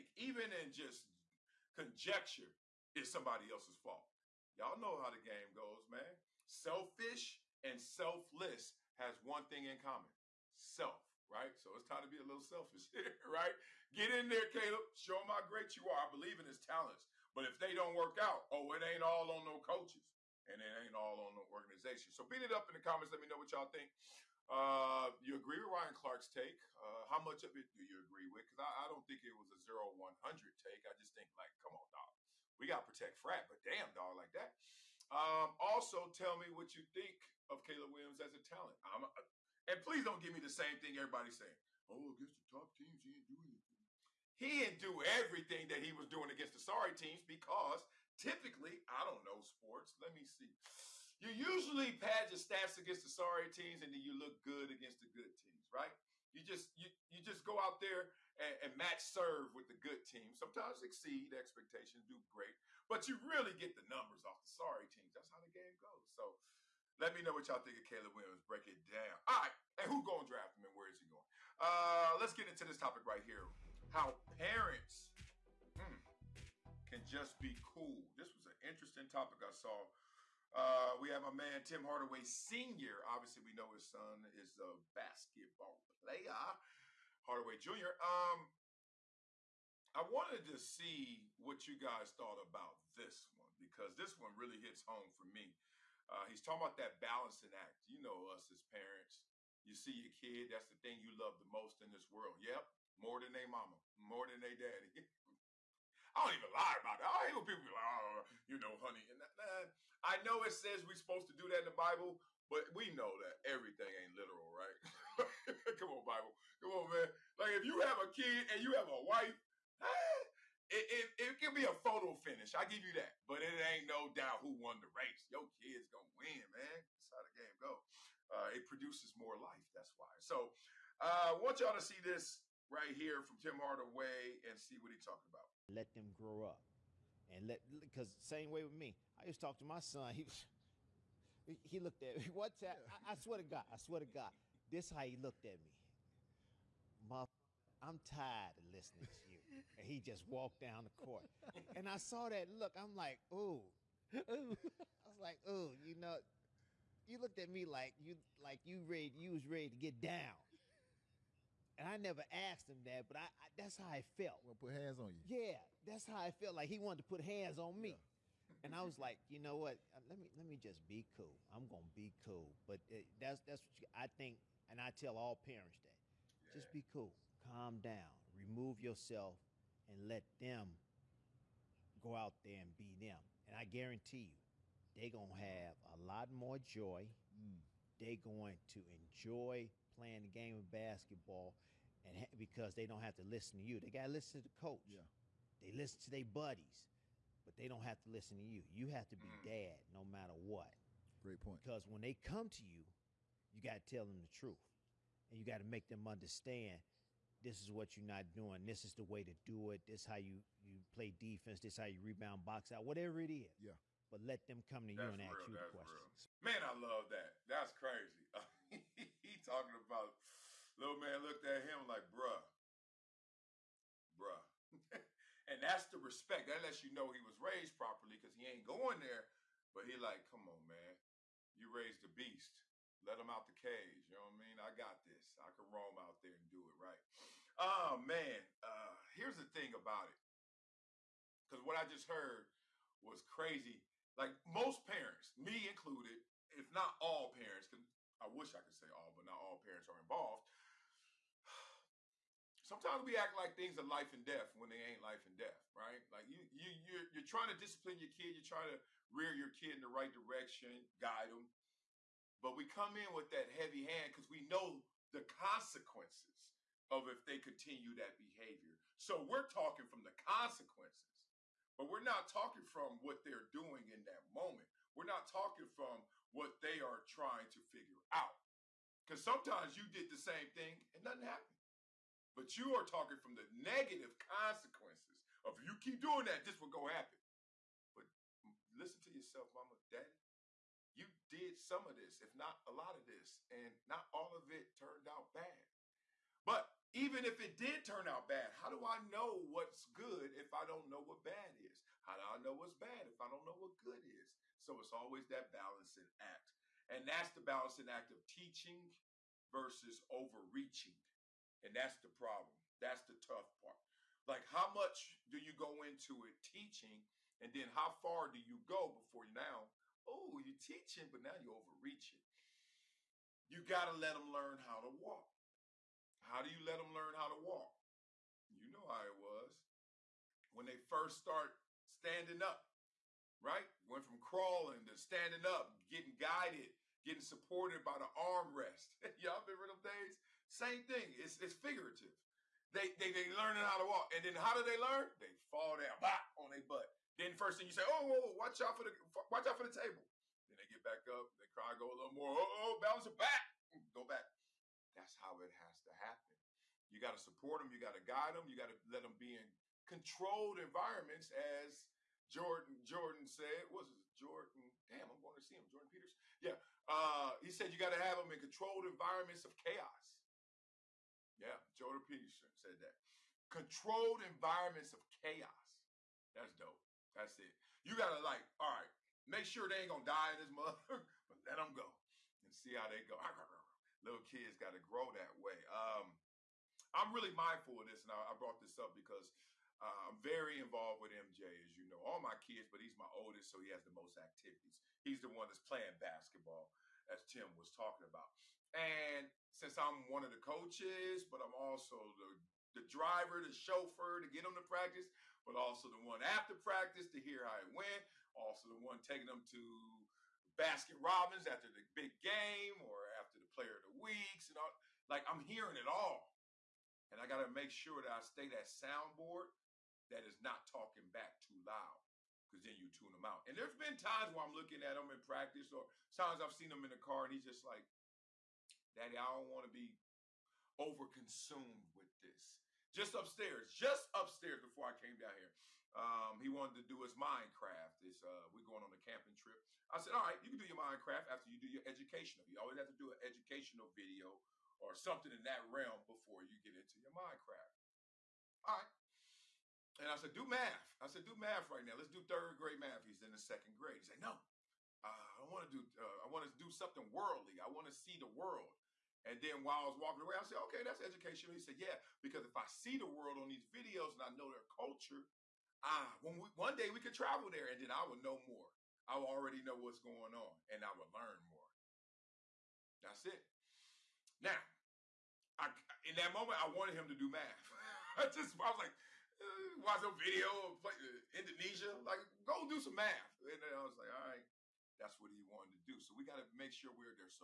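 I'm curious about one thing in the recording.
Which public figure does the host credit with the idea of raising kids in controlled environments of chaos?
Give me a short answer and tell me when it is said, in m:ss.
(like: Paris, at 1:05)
Jordan Peterson, at 6:11.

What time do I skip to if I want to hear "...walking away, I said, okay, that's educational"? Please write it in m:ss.
7:39.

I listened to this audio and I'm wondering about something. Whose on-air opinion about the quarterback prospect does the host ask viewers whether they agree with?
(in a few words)
Ryan Clark.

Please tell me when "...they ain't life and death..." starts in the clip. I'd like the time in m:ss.
4:14.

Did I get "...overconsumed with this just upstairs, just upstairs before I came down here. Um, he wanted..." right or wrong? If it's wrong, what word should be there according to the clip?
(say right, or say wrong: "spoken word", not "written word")
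right.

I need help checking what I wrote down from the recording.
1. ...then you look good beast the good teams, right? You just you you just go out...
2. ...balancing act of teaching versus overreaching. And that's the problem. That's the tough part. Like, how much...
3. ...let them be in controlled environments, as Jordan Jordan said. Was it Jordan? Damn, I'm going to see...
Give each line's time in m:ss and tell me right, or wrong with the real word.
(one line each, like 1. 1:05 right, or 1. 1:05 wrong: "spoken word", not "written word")
1. 0:53 wrong: "against", not "beast"
2. 5:07 right
3. 5:58 right.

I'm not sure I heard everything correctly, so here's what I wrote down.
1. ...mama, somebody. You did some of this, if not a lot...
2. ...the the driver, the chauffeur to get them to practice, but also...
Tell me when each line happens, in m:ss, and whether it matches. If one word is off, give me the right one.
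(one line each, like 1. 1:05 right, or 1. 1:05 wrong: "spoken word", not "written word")
1. 4:49 wrong: "daddy", not "somebody"
2. 6:42 right.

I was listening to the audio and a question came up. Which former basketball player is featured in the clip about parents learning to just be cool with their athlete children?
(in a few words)
Tim Hardaway Sr.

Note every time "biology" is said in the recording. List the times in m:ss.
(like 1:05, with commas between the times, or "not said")
not said.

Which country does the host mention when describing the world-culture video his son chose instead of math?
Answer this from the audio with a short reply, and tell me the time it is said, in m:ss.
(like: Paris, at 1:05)
Indonesia, at 8:01.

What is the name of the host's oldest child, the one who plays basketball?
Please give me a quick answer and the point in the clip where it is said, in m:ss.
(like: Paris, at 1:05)
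MJ, at 6:31.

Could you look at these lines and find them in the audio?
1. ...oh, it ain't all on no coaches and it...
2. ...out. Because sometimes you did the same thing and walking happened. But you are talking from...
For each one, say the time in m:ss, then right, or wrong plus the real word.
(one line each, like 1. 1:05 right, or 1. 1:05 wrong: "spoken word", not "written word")
1. 0:18 right
2. 4:38 wrong: "nothing", not "walking".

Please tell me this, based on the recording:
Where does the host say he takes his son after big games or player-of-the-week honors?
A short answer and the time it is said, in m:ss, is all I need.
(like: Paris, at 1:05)
Baskin Robbins, at 6:50.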